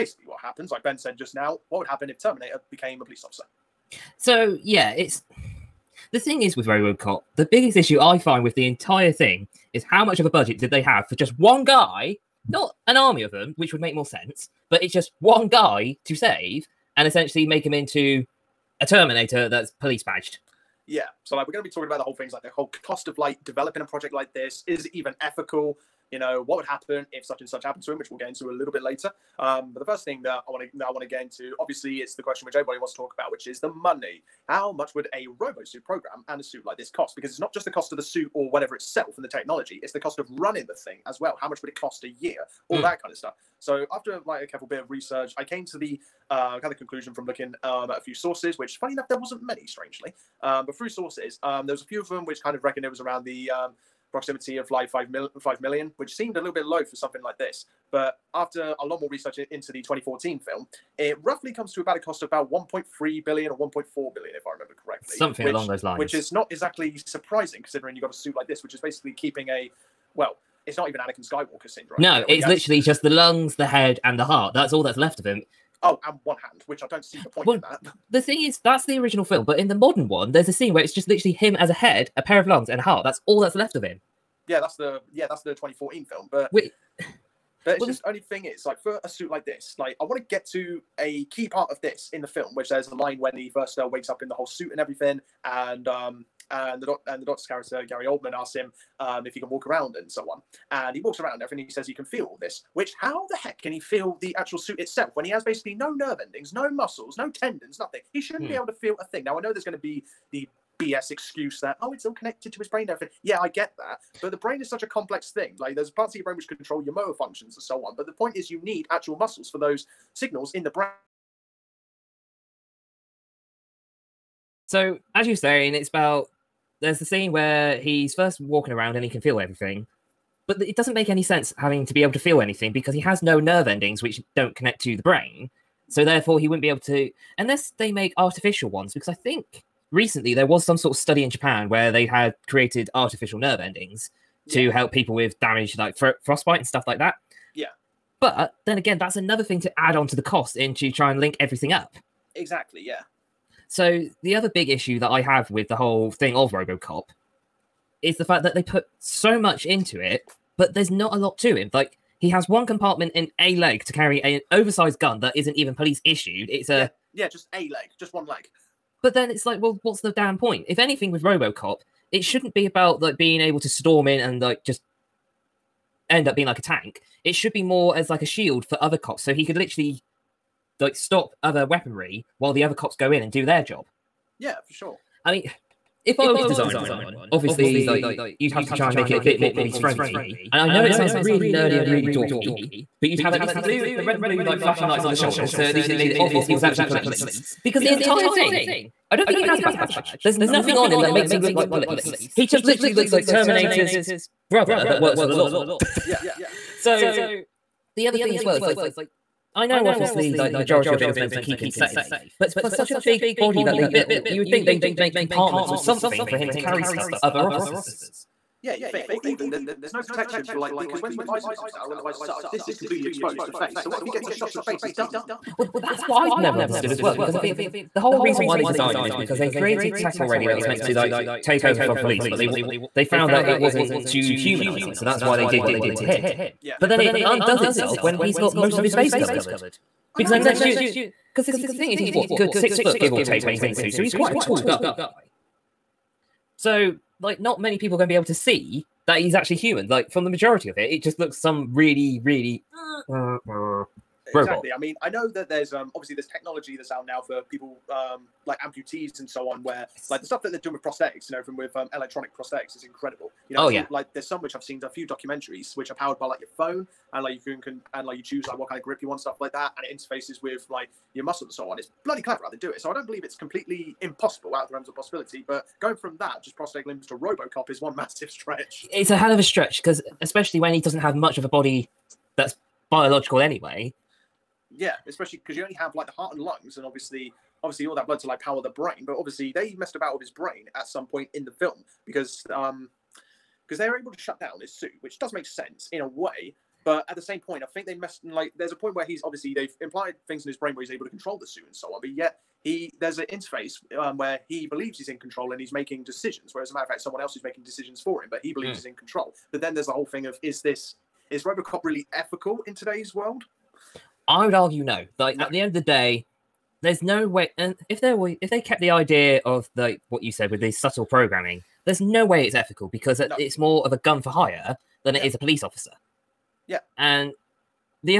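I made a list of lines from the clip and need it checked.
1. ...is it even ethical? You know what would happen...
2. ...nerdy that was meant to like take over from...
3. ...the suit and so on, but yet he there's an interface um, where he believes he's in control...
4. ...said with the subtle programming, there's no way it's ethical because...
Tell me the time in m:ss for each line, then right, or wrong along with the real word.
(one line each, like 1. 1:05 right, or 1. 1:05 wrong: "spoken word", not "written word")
1. 0:24 right
2. 3:50 wrong: "already", not "nerdy"
3. 5:01 right
4. 5:20 right.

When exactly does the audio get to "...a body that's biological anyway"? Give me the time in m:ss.
4:41.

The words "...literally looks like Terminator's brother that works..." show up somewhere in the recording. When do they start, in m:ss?
3:22.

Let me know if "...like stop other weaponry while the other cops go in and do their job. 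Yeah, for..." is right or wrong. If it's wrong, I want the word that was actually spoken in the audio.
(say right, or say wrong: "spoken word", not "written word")
right.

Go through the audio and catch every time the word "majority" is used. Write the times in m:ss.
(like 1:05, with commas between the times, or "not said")
3:30, 4:10.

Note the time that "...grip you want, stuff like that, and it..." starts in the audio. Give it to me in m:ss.
4:28.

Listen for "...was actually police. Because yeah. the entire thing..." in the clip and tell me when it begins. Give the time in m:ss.
3:16.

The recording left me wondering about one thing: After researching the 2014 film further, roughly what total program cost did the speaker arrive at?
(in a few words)
1.3 billion.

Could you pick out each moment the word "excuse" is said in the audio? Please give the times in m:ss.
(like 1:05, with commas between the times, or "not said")
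1:51.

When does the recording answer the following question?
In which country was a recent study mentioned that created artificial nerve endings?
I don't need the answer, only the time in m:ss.
2:21.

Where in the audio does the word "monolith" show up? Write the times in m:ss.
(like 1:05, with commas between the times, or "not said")
not said.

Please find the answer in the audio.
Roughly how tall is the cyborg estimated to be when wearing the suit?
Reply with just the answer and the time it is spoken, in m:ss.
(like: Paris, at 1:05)
6 foot, at 4:02.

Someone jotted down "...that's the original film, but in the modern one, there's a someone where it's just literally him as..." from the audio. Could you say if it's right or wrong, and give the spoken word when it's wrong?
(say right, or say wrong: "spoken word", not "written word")
wrong: "scene", not "someone".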